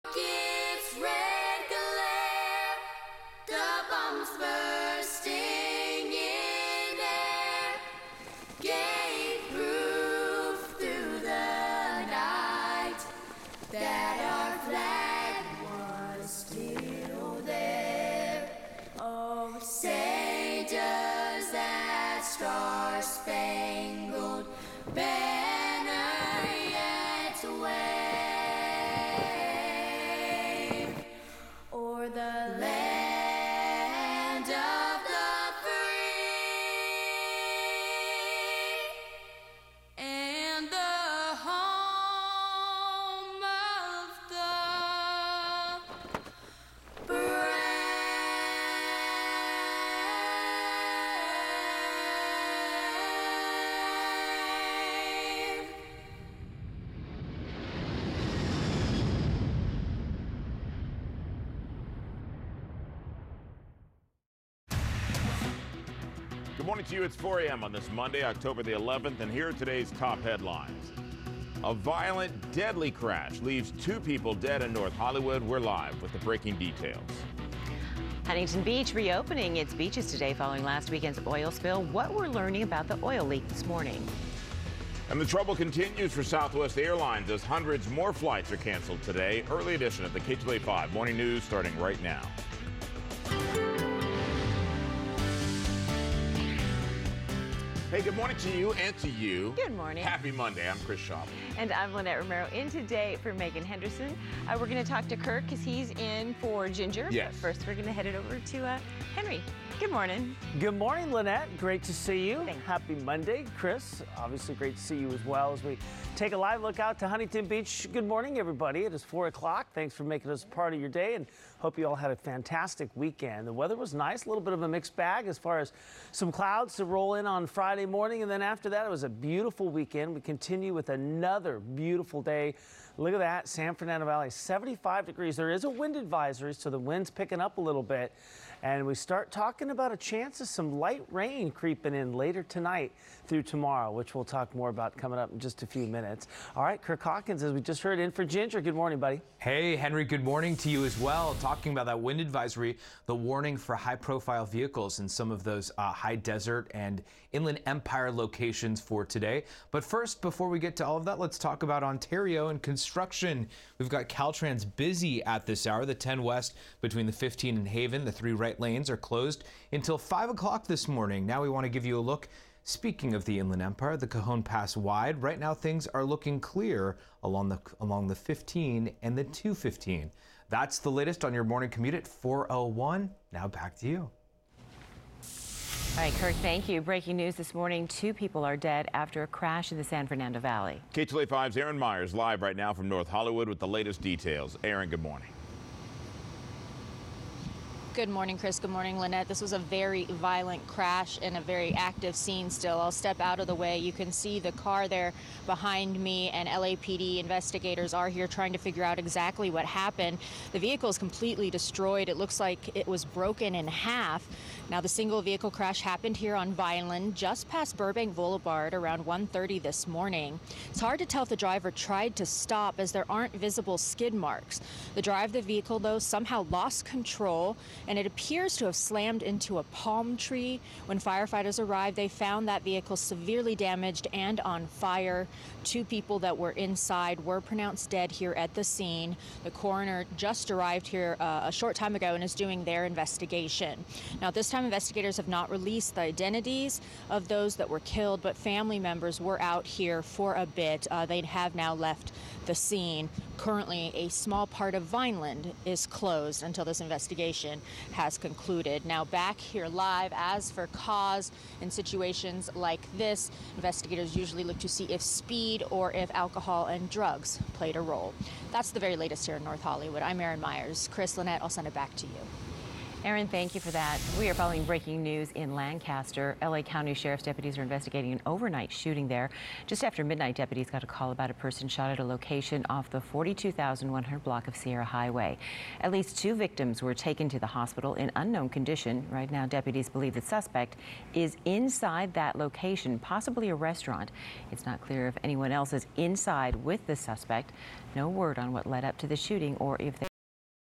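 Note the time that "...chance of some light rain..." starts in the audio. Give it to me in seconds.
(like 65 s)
139 s.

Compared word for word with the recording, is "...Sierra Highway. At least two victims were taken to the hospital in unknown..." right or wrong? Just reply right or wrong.
right.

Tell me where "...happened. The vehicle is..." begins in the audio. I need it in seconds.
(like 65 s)
209 s.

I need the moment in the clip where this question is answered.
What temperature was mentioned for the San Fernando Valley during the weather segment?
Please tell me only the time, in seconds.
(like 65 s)
134 s.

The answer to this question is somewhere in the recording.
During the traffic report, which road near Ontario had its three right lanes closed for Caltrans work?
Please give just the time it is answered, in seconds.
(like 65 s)
165 s.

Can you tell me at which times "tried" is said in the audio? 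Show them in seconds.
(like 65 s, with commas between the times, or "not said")
221 s.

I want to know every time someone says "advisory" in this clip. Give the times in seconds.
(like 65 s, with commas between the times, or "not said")
135 s, 152 s.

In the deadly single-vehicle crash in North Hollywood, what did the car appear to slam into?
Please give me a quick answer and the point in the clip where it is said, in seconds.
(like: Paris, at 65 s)
palm tree, at 229 s.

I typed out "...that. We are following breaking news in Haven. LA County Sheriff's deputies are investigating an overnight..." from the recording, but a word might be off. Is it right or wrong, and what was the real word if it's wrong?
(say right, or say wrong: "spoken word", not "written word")
wrong: "Lancaster", not "Haven".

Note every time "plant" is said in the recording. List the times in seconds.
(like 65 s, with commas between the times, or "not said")
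not said.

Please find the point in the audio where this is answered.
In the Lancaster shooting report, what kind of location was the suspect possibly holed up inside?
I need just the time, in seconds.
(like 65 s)
293 s.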